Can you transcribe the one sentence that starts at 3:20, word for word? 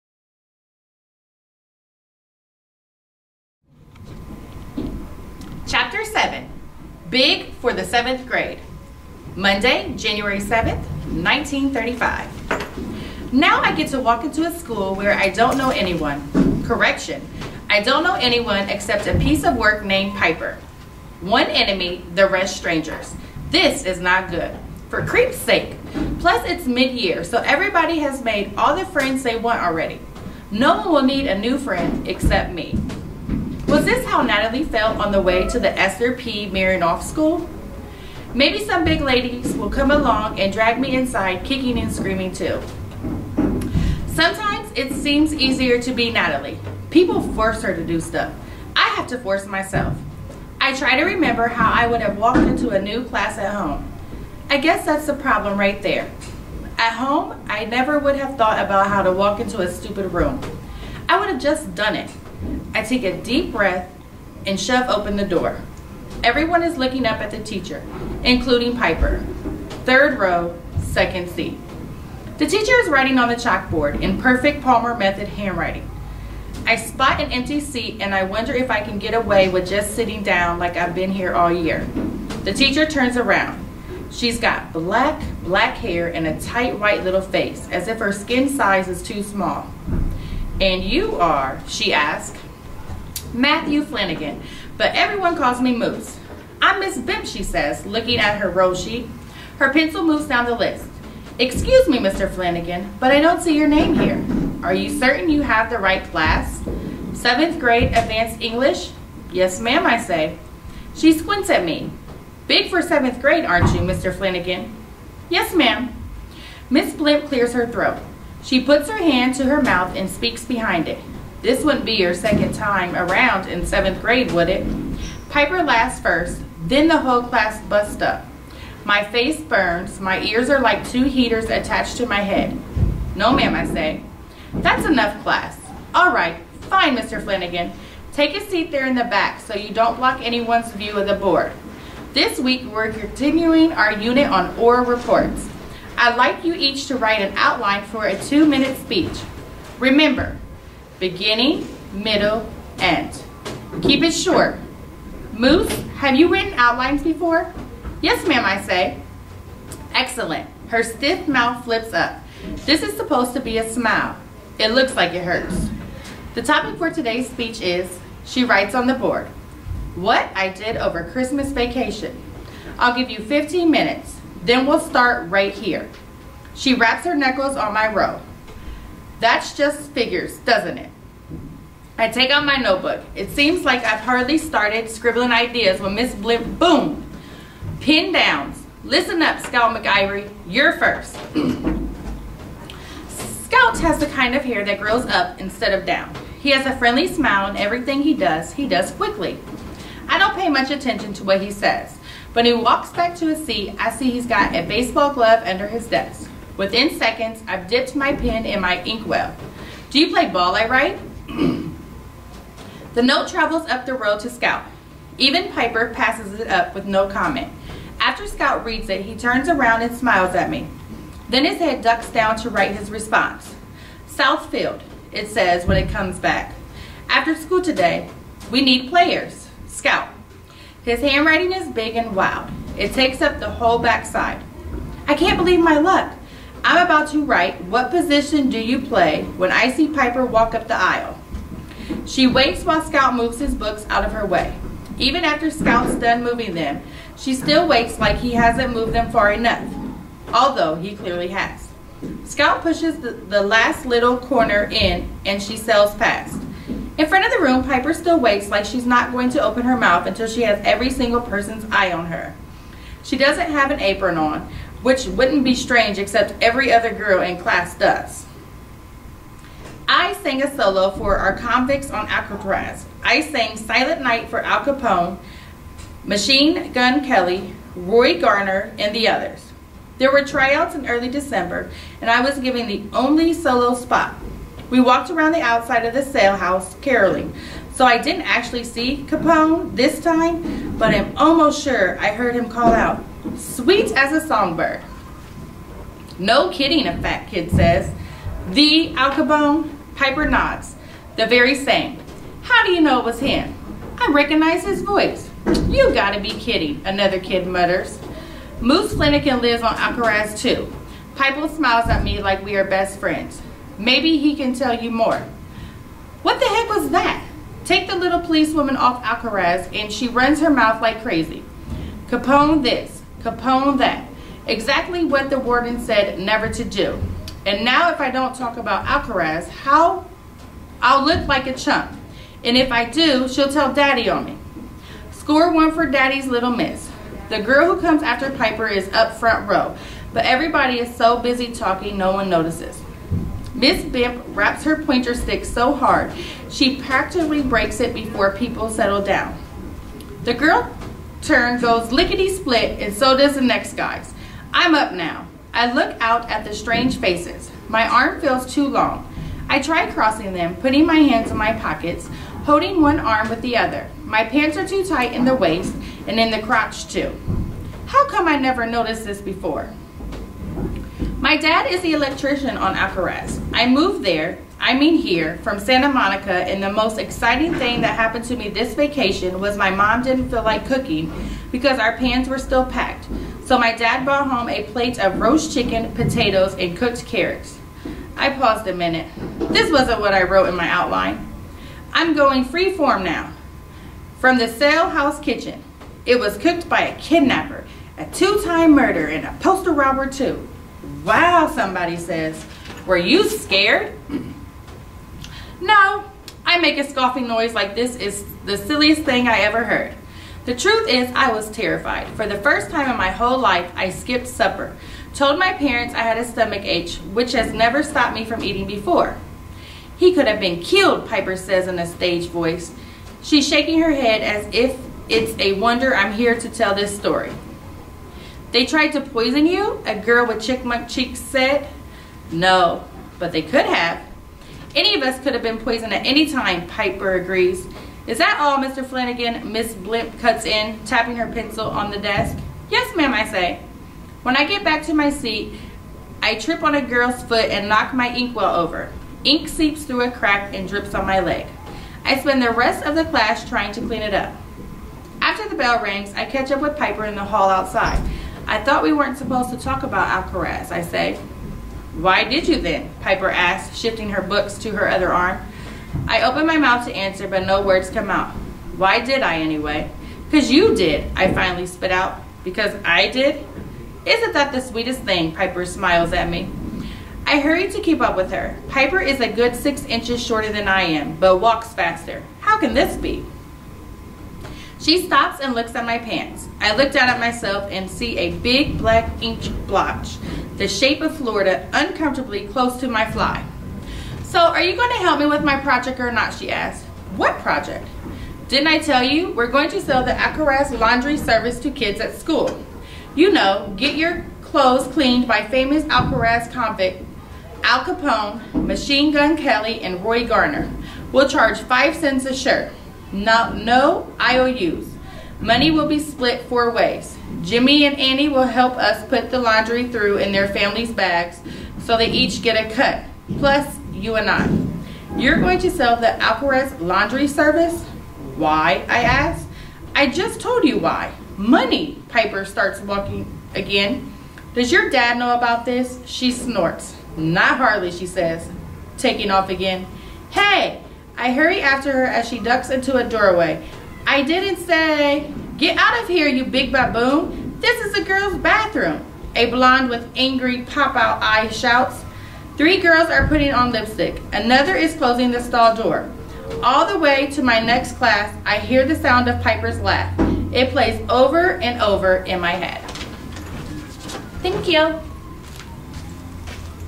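I don't pay much attention to what he says.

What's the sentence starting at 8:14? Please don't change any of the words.
So are you going to help me with my project or not, she asks.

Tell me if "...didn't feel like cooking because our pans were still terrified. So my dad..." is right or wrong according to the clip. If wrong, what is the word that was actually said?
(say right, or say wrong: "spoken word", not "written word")
wrong: "packed", not "terrified".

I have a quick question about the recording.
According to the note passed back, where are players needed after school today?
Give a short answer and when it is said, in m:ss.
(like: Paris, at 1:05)
Southfield, at 3:44.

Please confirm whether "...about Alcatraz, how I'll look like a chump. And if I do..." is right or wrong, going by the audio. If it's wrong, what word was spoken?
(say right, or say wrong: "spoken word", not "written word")
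right.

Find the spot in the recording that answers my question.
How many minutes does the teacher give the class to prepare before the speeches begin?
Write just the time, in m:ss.
2:53.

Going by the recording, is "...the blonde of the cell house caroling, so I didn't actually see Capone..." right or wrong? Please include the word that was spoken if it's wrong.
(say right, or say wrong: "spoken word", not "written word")
wrong: "outside", not "blonde".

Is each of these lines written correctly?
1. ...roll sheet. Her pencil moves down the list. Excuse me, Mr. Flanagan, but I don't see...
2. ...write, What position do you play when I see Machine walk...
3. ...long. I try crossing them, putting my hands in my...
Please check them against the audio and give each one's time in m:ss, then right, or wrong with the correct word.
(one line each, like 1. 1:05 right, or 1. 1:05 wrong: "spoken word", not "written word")
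1. 1:38 right
2. 3:57 wrong: "Piper", not "Machine"
3. 5:58 right.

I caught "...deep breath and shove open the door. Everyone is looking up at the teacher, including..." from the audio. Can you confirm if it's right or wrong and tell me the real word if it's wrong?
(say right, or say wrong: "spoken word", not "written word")
right.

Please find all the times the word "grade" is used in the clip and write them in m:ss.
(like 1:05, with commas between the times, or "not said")
0:08, 1:47, 1:53, 2:03.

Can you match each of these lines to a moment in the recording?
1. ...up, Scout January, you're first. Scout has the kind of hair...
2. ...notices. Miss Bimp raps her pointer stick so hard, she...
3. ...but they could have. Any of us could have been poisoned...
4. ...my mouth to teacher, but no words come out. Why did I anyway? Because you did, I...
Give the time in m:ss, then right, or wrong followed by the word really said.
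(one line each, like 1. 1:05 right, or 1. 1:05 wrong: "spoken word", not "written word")
1. 3:09 wrong: "McIvory", not "January"
2. 5:42 right
3. 7:13 right
4. 7:46 wrong: "answer", not "teacher".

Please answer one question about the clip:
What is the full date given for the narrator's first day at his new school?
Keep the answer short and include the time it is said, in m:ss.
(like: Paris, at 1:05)
Monday, January 7th, 1935, at 0:09.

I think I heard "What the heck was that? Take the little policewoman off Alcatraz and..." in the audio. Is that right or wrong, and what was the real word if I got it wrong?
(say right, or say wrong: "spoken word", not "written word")
right.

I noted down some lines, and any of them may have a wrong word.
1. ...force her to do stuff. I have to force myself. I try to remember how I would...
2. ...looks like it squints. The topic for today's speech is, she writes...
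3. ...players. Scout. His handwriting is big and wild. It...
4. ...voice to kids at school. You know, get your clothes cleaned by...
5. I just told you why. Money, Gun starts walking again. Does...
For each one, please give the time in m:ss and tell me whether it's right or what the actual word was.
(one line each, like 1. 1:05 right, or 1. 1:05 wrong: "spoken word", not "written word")
1. 0:47 right
2. 2:44 wrong: "hurts", not "squints"
3. 3:48 right
4. 8:21 wrong: "service", not "voice"
5. 8:49 wrong: "Piper", not "Gun".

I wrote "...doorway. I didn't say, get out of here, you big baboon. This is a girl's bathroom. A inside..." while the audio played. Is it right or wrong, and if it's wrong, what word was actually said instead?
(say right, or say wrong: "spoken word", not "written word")
wrong: "blonde", not "inside".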